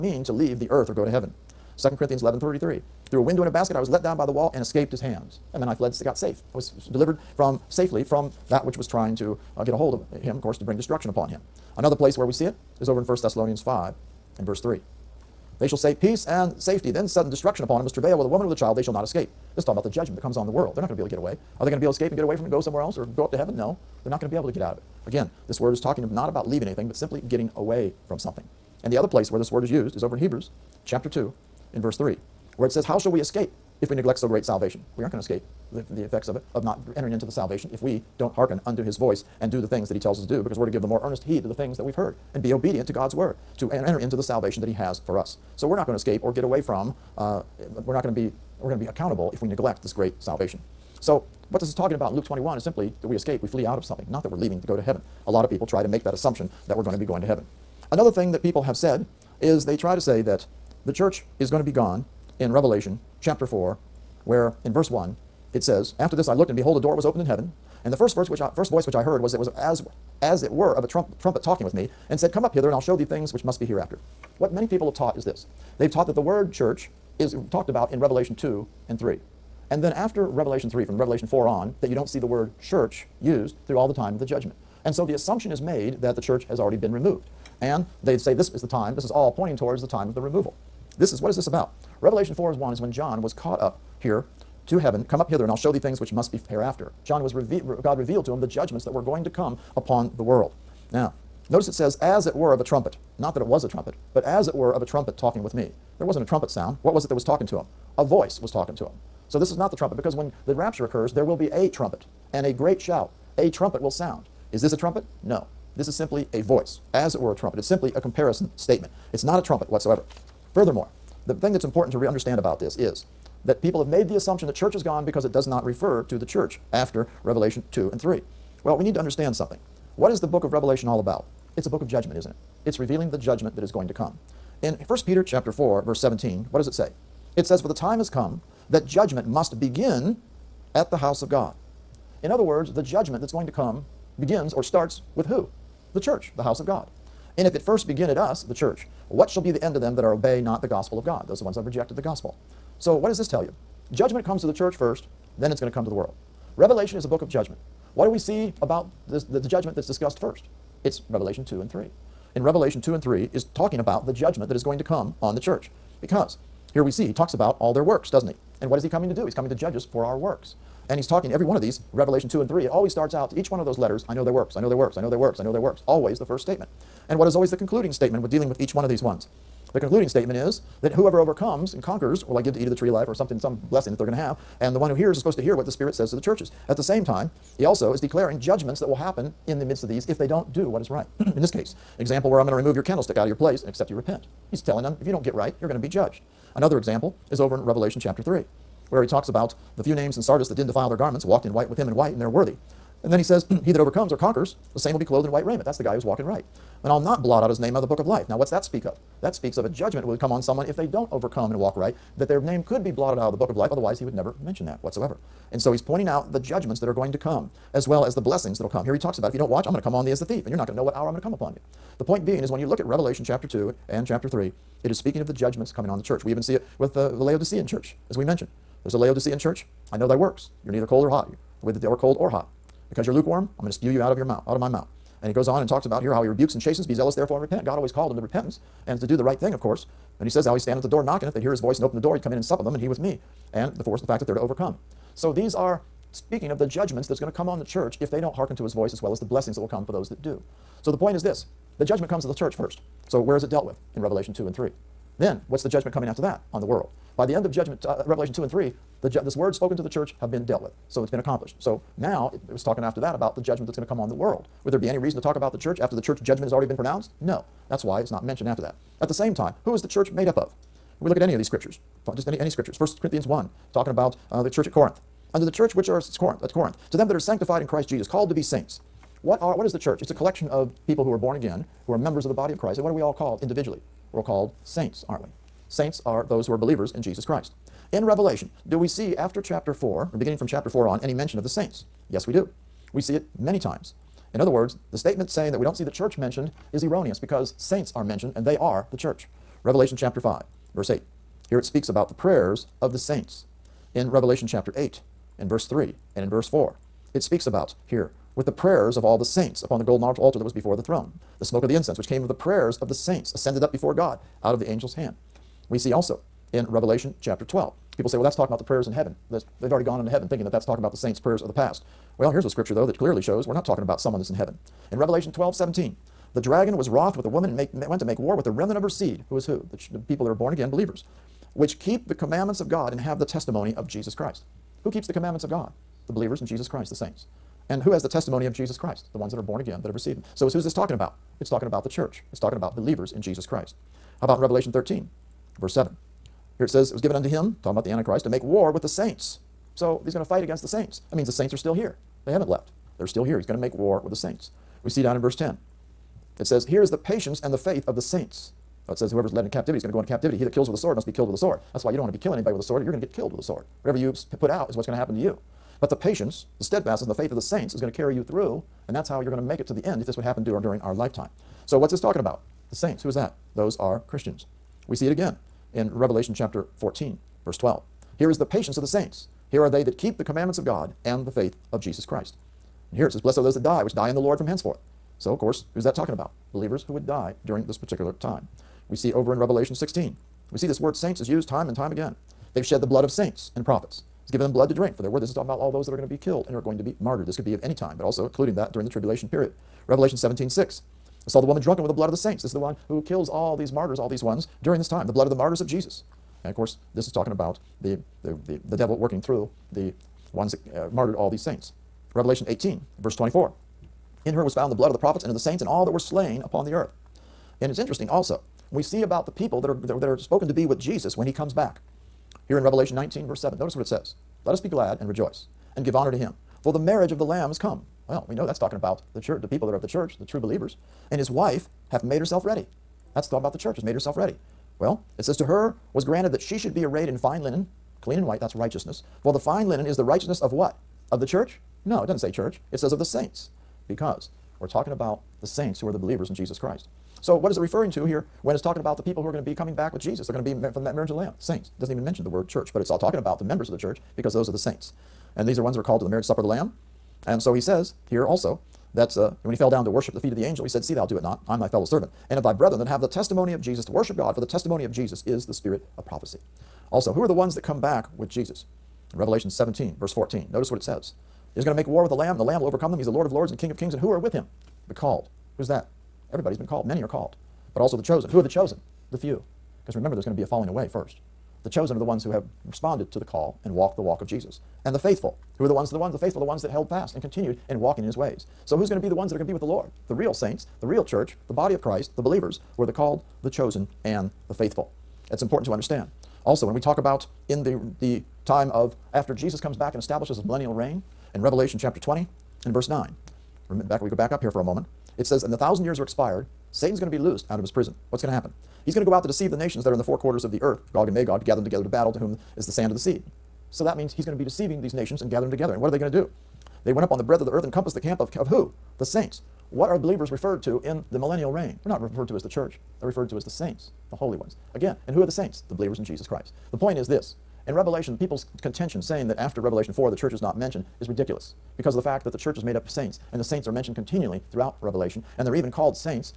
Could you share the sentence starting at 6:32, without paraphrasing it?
They've shed the blood of saints and prophets.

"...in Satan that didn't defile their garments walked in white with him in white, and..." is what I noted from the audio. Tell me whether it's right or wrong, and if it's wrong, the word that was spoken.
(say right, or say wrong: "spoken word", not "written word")
wrong: "Sardis", not "Satan".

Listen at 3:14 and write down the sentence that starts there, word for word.
He's telling them, if you don't get right, you're going to be judged.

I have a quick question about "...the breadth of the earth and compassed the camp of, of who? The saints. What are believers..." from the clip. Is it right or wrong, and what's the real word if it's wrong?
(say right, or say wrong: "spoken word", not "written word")
right.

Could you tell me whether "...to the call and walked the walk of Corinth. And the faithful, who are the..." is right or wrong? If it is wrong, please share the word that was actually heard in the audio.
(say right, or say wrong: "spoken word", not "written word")
wrong: "Jesus", not "Corinth".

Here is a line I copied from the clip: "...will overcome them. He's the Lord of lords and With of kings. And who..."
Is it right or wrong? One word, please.
wrong.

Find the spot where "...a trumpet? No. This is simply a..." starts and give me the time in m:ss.
1:54.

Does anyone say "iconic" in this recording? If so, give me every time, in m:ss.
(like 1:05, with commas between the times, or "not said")
not said.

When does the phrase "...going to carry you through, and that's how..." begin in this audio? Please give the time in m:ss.
6:07.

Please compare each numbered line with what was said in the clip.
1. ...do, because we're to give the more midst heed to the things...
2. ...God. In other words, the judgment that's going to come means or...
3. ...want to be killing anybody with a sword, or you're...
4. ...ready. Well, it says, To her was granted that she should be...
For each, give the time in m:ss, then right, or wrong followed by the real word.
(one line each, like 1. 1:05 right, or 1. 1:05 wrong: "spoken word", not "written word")
1. 0:40 wrong: "earnest", not "midst"
2. 2:21 wrong: "begins", not "means"
3. 6:02 right
4. 7:14 right.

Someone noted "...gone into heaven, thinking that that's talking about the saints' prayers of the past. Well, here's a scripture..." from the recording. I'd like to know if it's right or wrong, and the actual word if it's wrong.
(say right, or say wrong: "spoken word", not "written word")
right.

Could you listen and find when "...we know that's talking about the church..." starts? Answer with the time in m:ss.
7:08.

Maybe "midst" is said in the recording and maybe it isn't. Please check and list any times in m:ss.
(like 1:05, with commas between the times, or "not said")
3:09.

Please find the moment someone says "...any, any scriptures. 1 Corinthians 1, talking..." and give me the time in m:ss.
4:32.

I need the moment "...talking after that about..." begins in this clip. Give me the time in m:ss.
4:22.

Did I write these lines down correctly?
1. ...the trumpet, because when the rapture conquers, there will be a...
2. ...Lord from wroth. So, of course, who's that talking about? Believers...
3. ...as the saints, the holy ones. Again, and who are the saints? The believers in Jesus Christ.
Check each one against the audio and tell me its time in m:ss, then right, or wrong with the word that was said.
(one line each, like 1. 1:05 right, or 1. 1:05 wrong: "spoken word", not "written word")
1. 1:49 wrong: "occurs", not "conquers"
2. 6:24 wrong: "henceforth", not "wroth"
3. 8:43 right.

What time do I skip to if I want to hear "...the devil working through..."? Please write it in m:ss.
6:48.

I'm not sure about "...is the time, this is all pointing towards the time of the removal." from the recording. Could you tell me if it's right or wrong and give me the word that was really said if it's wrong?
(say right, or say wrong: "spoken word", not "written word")
right.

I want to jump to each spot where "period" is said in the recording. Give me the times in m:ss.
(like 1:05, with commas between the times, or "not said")
6:39.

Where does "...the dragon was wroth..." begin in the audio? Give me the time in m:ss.
5:26.